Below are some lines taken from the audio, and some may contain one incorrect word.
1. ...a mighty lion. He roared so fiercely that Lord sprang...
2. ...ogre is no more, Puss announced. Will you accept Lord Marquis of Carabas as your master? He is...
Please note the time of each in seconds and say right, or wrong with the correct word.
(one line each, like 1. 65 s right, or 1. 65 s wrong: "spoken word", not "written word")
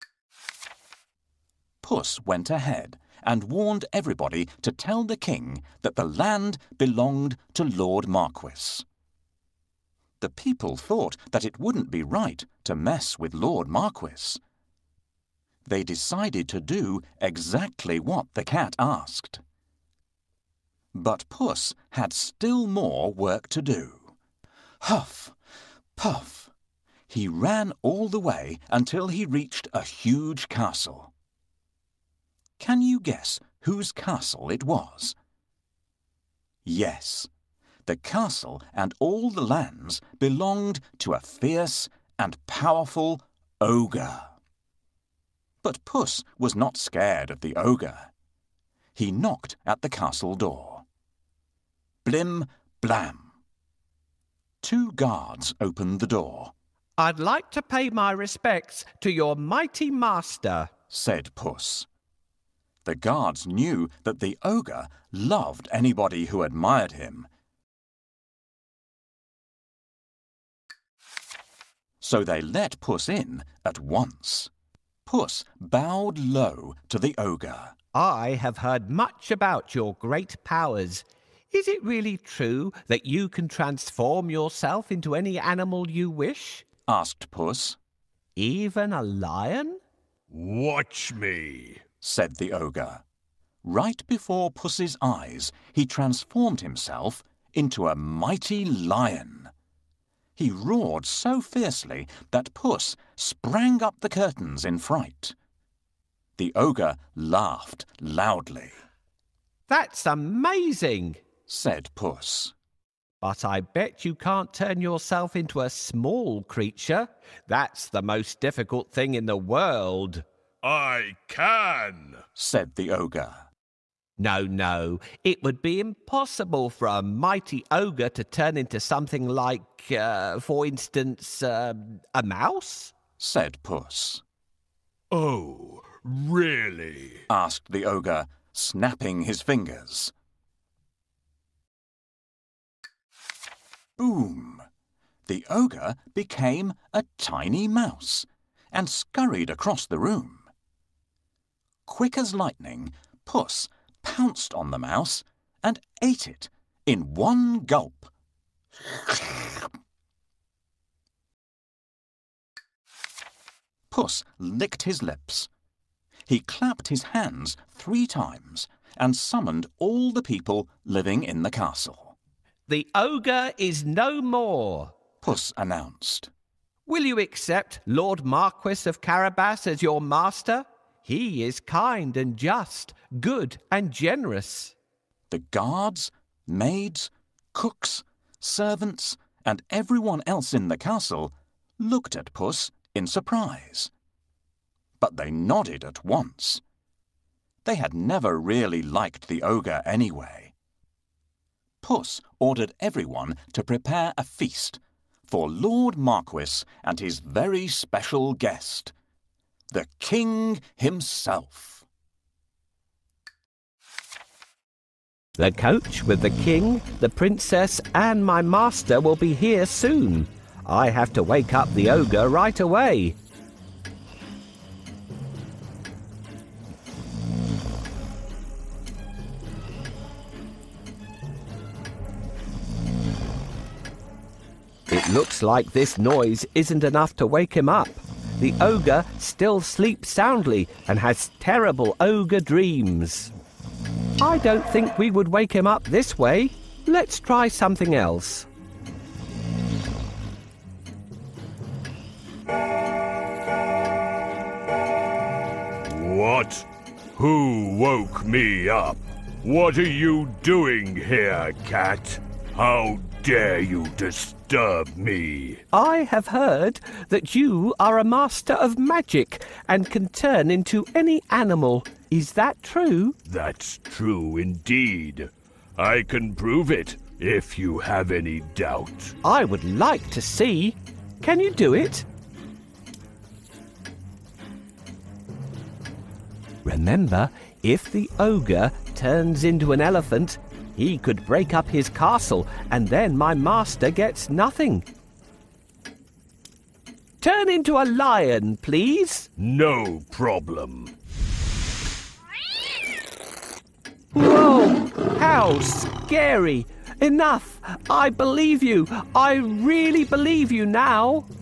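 1. 97 s wrong: "Puss", not "Lord"
2. 172 s right.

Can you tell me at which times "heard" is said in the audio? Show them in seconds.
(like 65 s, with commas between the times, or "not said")
78 s, 266 s.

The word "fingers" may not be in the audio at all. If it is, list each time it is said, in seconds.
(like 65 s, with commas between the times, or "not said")
139 s.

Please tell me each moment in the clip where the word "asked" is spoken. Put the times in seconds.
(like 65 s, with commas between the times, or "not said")
18 s, 86 s, 137 s.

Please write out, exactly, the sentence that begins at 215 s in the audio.
The coach with the king, the princess, and my master will be here soon.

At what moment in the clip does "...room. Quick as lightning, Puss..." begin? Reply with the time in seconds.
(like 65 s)
149 s.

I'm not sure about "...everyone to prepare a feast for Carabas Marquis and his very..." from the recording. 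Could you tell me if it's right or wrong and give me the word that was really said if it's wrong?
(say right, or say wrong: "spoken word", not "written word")
wrong: "Lord", not "Carabas".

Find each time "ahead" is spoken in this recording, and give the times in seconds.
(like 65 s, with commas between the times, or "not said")
2 s.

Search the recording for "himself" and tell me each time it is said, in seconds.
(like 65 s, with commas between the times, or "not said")
96 s, 210 s.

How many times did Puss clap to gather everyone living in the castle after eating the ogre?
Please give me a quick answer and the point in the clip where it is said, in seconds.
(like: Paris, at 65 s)
3, at 167 s.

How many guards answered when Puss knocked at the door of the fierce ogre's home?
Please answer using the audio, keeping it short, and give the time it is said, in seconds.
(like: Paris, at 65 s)
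2, at 54 s.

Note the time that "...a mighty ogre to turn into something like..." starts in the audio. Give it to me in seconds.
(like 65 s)
126 s.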